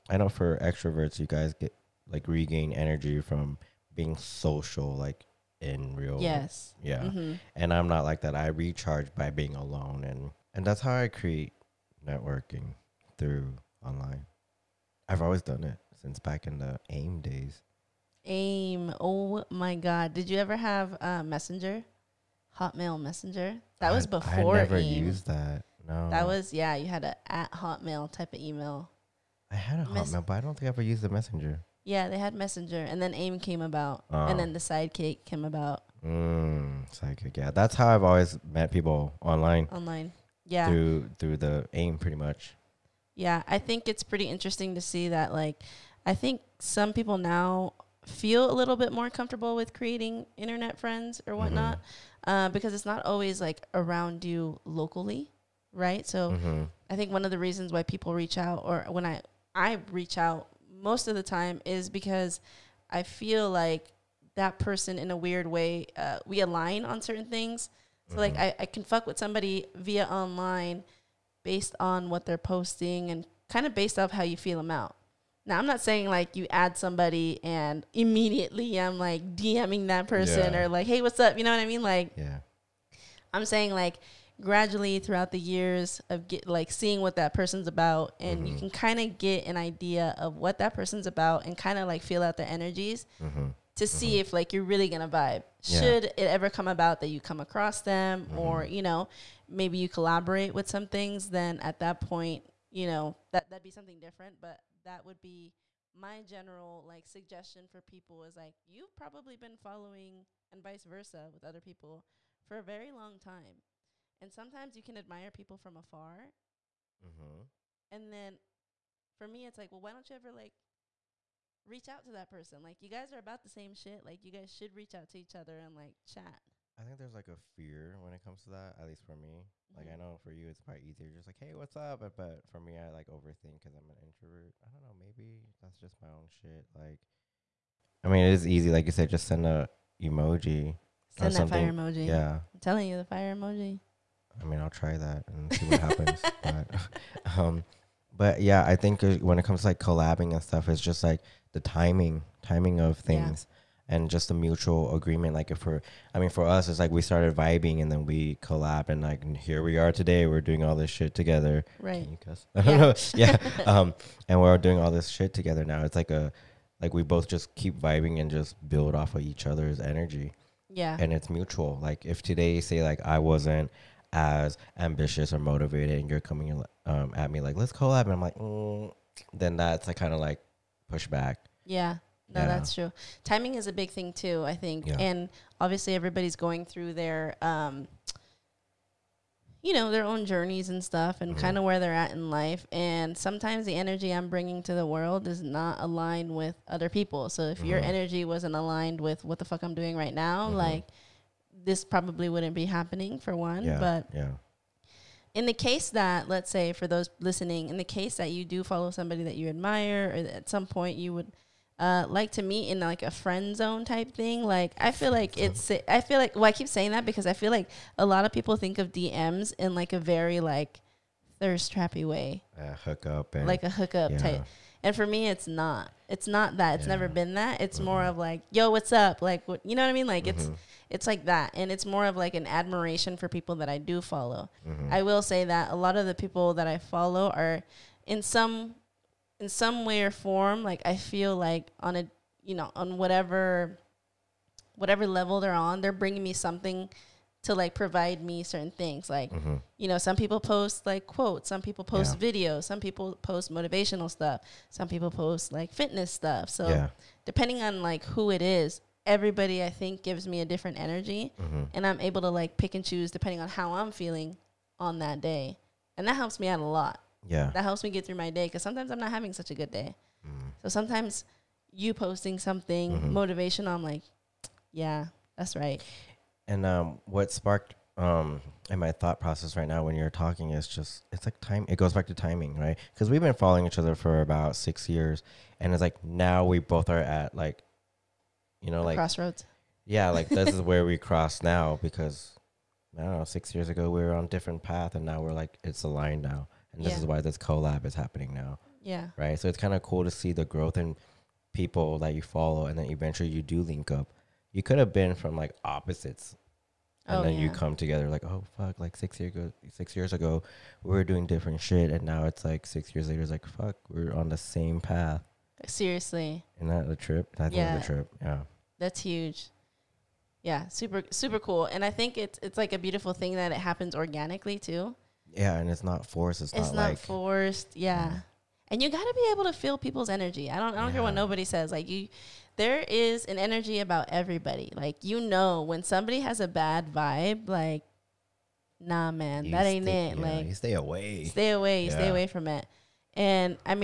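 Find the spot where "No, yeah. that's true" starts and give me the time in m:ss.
3:02.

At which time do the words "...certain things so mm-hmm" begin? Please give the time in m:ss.
1:07.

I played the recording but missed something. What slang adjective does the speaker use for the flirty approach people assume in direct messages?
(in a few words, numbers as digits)
Thirst trappy.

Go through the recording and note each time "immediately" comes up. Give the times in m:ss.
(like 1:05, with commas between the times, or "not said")
1:17.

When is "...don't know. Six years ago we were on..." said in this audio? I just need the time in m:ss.
4:53.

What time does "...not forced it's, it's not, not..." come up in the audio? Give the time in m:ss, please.
5:25.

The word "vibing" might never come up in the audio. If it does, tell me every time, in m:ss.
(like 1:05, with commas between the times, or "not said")
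2:37, 2:47.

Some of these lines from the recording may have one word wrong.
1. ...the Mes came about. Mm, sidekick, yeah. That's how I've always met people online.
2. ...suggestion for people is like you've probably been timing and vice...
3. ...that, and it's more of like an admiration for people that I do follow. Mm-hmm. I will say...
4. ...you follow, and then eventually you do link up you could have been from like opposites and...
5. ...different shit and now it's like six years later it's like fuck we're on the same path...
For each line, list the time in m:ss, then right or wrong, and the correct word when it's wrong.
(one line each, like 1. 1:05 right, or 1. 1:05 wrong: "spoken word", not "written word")
1. 0:34 wrong: "Sidekick", not "Mes"
2. 1:47 wrong: "following", not "timing"
3. 3:51 right
4. 5:02 right
5. 5:11 right.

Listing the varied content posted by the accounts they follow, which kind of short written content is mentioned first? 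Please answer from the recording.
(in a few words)
Quotes.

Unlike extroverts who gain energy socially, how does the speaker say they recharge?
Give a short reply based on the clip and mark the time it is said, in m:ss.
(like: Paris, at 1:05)
Being alone, at 0:09.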